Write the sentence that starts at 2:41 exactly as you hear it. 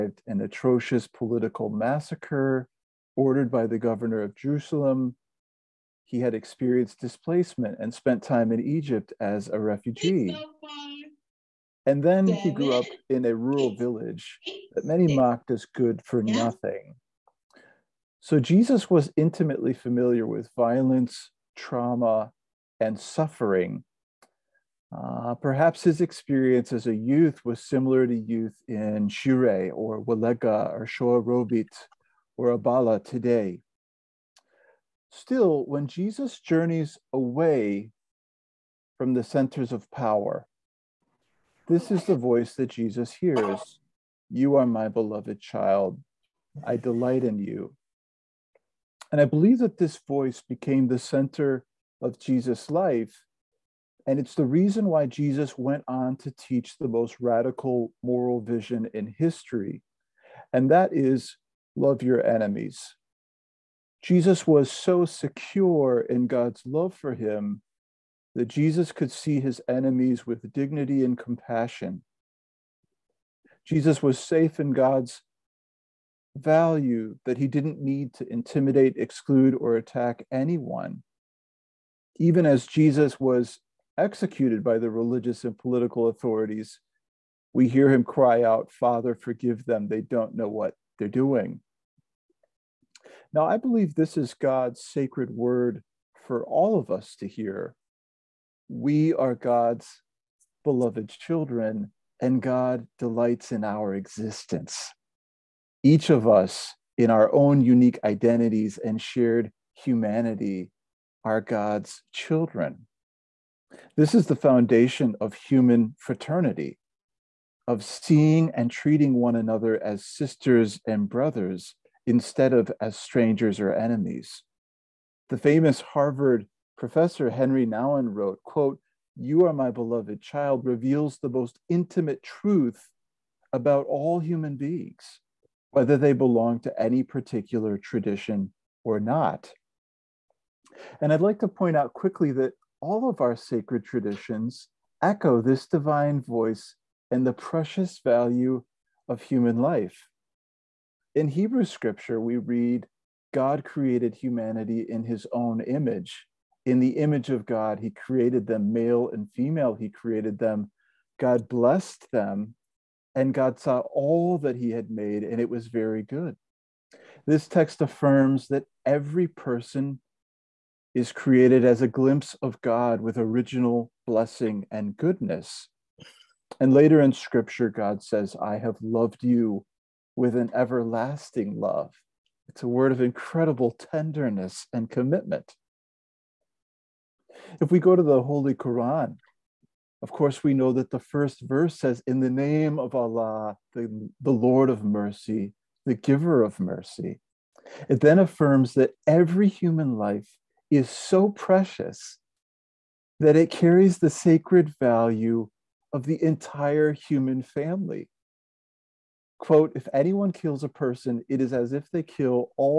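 God blessed them, and God saw all that he had made, and it was very good.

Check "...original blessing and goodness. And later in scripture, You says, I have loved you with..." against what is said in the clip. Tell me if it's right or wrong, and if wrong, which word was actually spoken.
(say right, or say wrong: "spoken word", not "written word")
wrong: "God", not "You".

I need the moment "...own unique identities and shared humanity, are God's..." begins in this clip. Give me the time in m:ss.
1:47.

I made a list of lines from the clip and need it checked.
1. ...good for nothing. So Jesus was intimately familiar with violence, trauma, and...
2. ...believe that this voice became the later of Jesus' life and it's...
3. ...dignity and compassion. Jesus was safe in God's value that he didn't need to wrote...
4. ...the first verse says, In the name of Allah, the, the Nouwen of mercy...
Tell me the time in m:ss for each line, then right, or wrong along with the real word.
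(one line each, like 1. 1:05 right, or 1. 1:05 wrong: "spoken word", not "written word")
1. 0:15 right
2. 0:49 wrong: "center", not "later"
3. 1:10 wrong: "intimidate", not "wrote"
4. 3:10 wrong: "Lord", not "Nouwen".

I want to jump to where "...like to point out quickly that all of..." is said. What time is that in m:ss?
2:21.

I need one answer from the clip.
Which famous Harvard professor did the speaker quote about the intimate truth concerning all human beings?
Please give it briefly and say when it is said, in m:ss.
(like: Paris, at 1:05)
Henri Nouwen, at 2:07.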